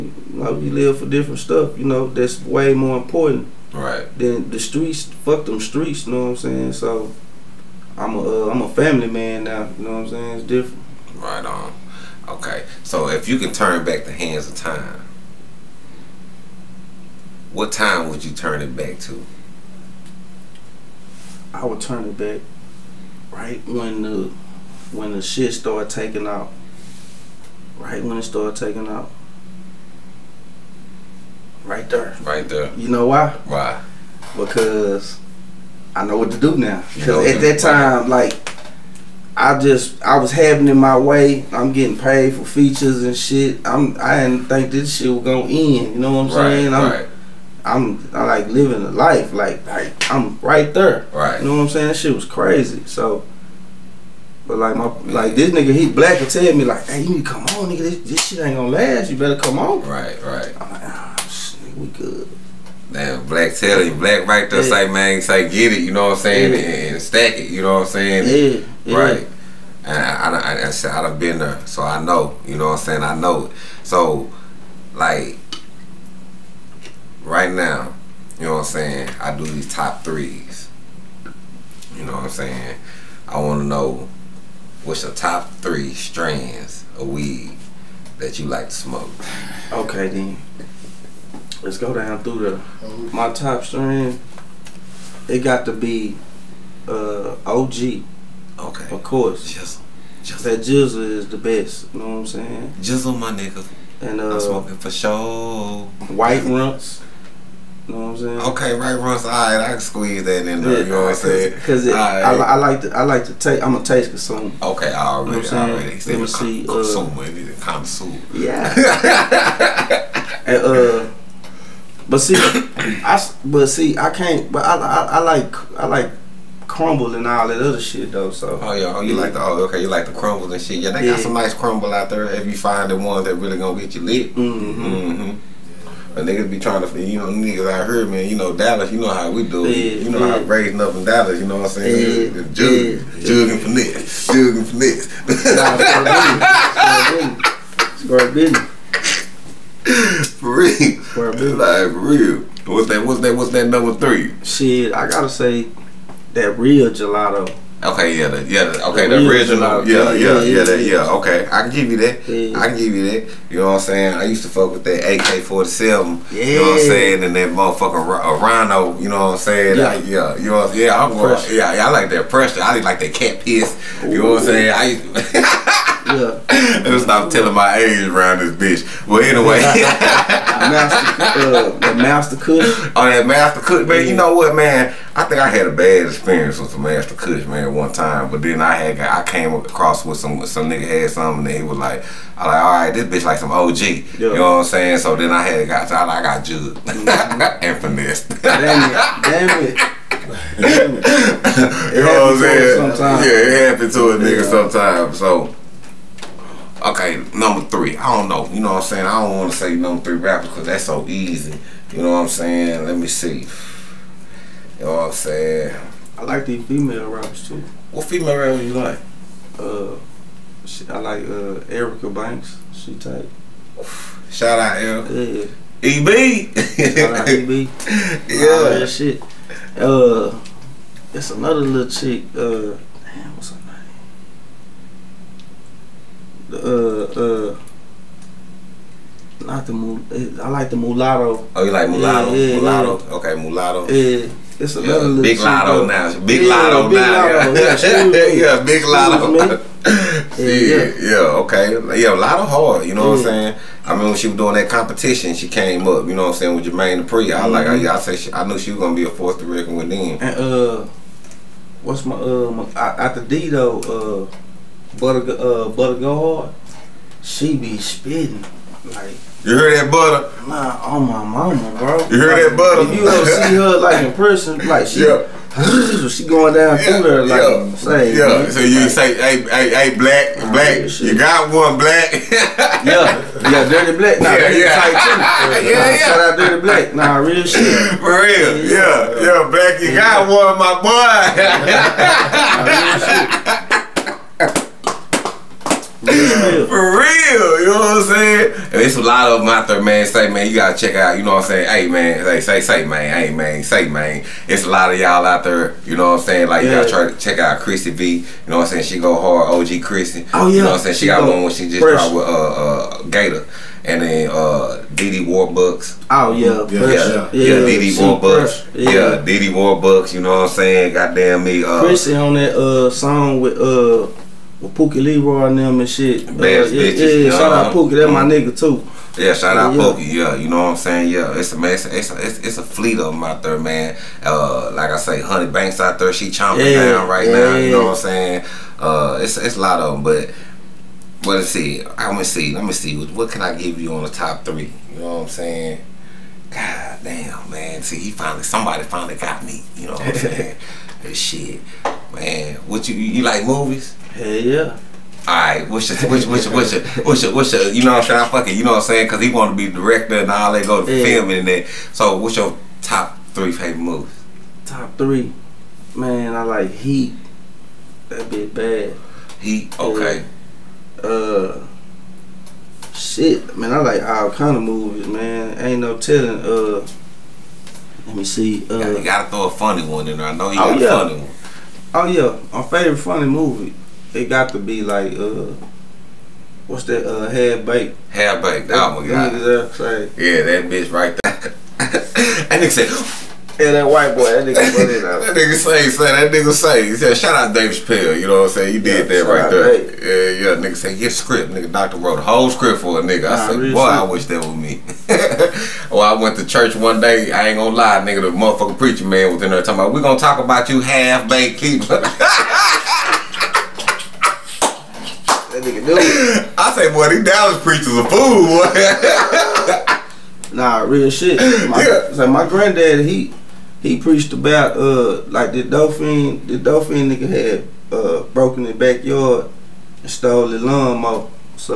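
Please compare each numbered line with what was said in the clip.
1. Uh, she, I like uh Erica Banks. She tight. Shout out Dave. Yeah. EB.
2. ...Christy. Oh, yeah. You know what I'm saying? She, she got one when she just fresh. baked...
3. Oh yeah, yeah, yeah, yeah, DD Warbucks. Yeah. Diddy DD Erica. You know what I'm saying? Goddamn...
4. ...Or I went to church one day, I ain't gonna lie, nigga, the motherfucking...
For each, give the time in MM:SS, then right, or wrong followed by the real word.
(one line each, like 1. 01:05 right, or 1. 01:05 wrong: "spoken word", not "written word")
1. 03:39 wrong: "Erica", not "Dave"
2. 05:09 wrong: "dropped", not "baked"
3. 05:16 wrong: "Warbucks", not "Erica"
4. 06:45 right.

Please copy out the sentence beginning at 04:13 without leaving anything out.
I mean, when she was doing that competition, she came up.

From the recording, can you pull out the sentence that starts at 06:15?
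Ain't no telling, uh let me see.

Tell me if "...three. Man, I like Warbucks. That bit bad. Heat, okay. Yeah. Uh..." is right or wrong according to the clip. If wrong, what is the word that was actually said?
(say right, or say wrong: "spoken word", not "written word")
wrong: "Heat", not "Warbucks".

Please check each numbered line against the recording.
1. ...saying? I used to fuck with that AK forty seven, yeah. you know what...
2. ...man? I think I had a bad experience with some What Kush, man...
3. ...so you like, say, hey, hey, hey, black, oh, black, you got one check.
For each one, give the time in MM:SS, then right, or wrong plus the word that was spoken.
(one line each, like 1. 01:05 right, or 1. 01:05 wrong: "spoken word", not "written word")
1. 02:43 right
2. 03:04 wrong: "Master", not "What"
3. 04:38 wrong: "black", not "check".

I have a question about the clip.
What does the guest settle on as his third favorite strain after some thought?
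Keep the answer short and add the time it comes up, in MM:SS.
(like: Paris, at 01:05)
Gelato, at 02:36.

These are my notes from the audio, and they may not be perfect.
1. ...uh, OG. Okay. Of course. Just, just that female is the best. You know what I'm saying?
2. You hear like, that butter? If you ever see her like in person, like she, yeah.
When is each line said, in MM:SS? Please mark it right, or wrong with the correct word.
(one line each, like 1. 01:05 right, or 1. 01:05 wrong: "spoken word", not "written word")
1. 01:36 wrong: "jizzle", not "female"
2. 04:32 right.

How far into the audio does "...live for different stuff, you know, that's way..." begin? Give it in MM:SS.
00:00.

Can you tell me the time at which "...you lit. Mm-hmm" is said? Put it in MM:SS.
02:13.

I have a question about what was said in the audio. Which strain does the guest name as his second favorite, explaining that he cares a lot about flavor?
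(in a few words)
White Runtz.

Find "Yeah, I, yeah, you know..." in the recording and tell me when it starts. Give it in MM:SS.
02:49.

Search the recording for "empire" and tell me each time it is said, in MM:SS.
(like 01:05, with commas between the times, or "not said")
not said.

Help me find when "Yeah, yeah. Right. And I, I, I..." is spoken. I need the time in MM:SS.
01:08.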